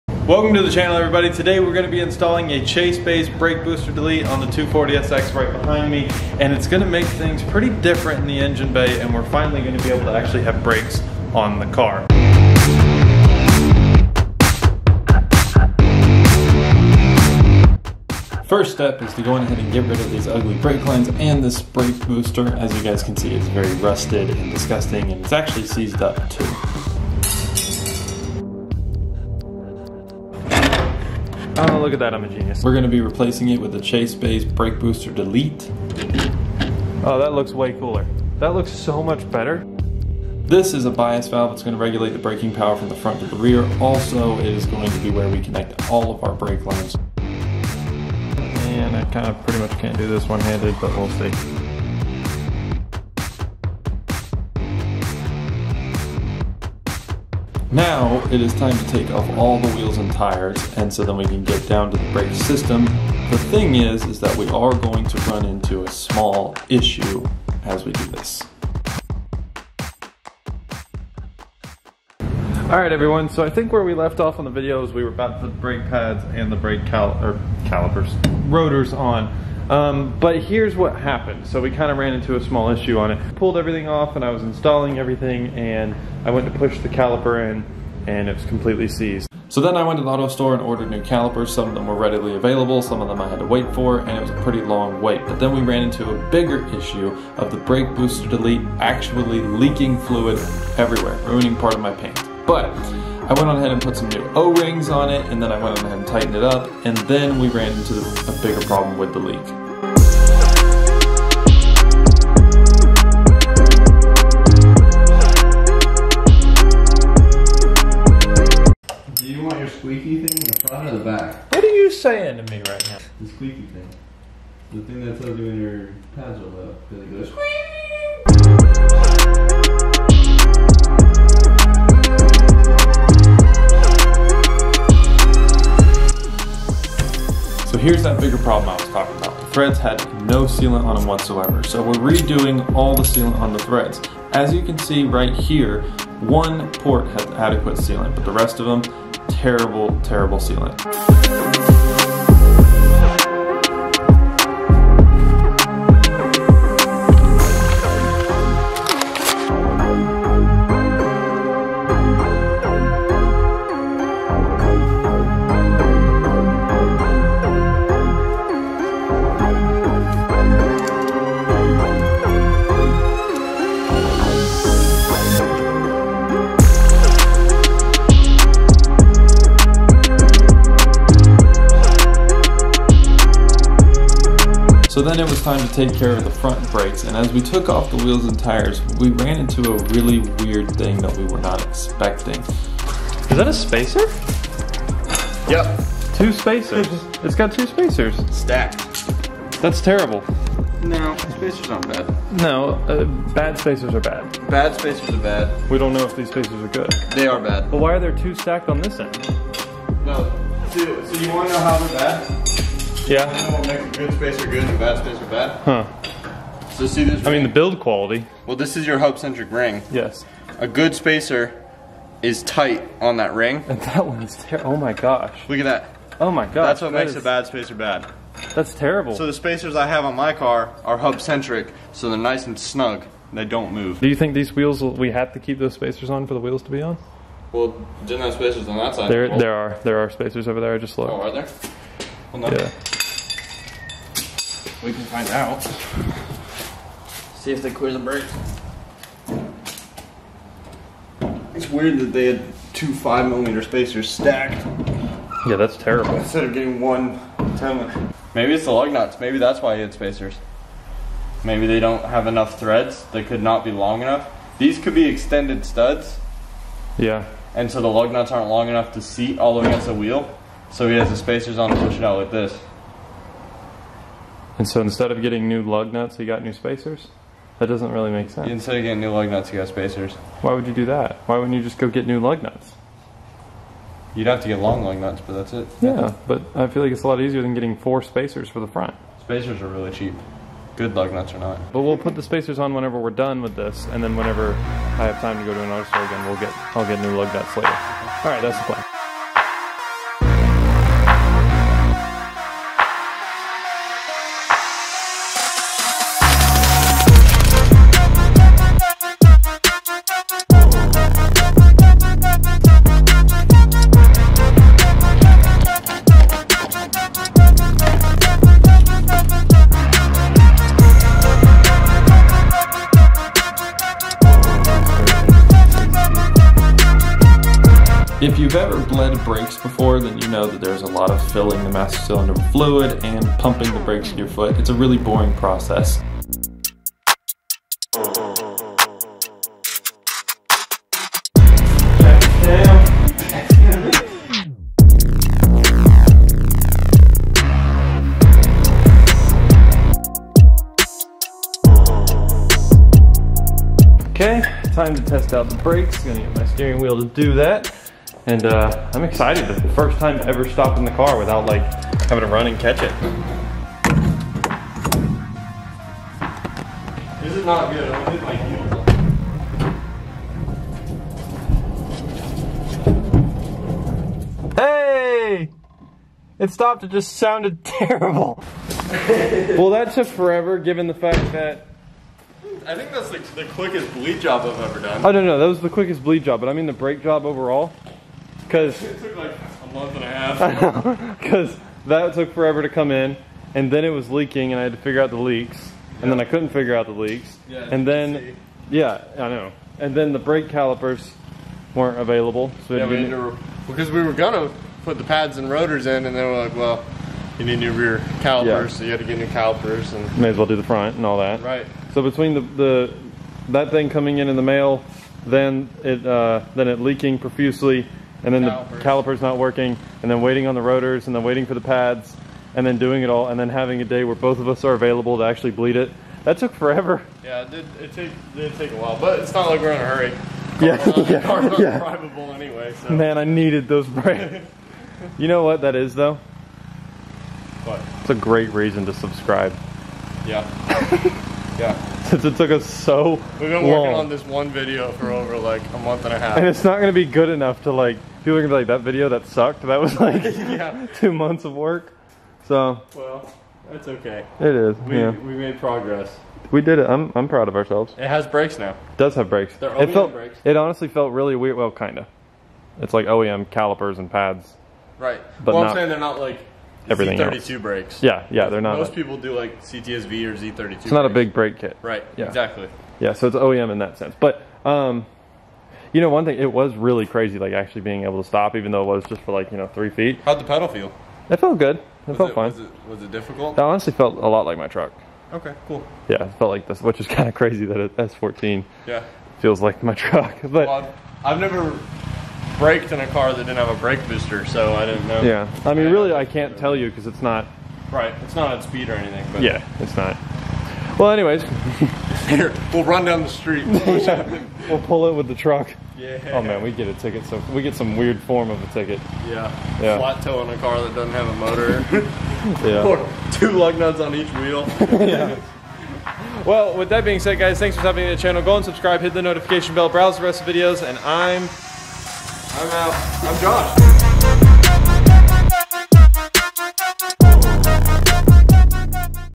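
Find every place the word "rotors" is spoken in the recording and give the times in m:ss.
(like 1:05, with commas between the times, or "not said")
1:18, 6:45, 7:00.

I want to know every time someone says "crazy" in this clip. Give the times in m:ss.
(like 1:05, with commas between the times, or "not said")
7:57, 8:07.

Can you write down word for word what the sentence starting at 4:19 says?
Maybe that's why he had spacers.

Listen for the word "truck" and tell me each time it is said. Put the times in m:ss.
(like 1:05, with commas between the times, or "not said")
8:04, 8:09, 8:25.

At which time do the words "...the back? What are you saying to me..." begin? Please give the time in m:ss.
2:00.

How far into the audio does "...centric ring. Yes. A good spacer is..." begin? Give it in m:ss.
3:39.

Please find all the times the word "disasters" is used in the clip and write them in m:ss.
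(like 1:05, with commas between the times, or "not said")
not said.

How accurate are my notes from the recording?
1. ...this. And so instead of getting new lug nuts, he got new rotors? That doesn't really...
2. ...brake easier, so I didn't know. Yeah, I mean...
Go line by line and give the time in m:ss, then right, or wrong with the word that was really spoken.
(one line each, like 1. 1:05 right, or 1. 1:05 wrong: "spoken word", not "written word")
1. 4:32 wrong: "spacers", not "rotors"
2. 8:13 wrong: "booster", not "easier".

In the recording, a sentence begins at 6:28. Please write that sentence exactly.
Because it took like a month and a half.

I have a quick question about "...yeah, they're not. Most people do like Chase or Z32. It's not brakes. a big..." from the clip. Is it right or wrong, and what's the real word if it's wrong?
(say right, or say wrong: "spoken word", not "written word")
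wrong: "CTSV", not "Chase".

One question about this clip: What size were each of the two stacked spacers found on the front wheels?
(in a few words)
5 millimeters.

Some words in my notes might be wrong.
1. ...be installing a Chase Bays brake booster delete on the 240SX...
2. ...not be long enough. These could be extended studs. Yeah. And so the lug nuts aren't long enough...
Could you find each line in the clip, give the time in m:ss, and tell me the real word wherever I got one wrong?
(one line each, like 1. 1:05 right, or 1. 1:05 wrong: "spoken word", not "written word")
1. 0:01 right
2. 4:23 right.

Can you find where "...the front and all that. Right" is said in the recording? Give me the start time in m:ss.
6:50.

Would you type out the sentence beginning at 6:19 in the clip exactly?
well, that took forever, given the fact that...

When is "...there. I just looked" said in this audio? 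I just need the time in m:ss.
4:00.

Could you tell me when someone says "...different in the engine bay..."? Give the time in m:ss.
0:07.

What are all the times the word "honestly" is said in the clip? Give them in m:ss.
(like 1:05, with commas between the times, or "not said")
7:40, 8:03.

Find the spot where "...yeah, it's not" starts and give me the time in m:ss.
8:19.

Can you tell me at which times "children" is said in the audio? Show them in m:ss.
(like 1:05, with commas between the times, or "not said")
not said.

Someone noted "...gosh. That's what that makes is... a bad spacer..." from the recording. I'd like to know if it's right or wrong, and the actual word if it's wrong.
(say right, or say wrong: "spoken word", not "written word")
right.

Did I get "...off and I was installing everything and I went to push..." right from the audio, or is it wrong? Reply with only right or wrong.
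right.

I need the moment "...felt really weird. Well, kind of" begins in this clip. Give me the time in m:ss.
7:40.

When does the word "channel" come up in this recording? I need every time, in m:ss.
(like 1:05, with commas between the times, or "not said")
0:00, 8:38.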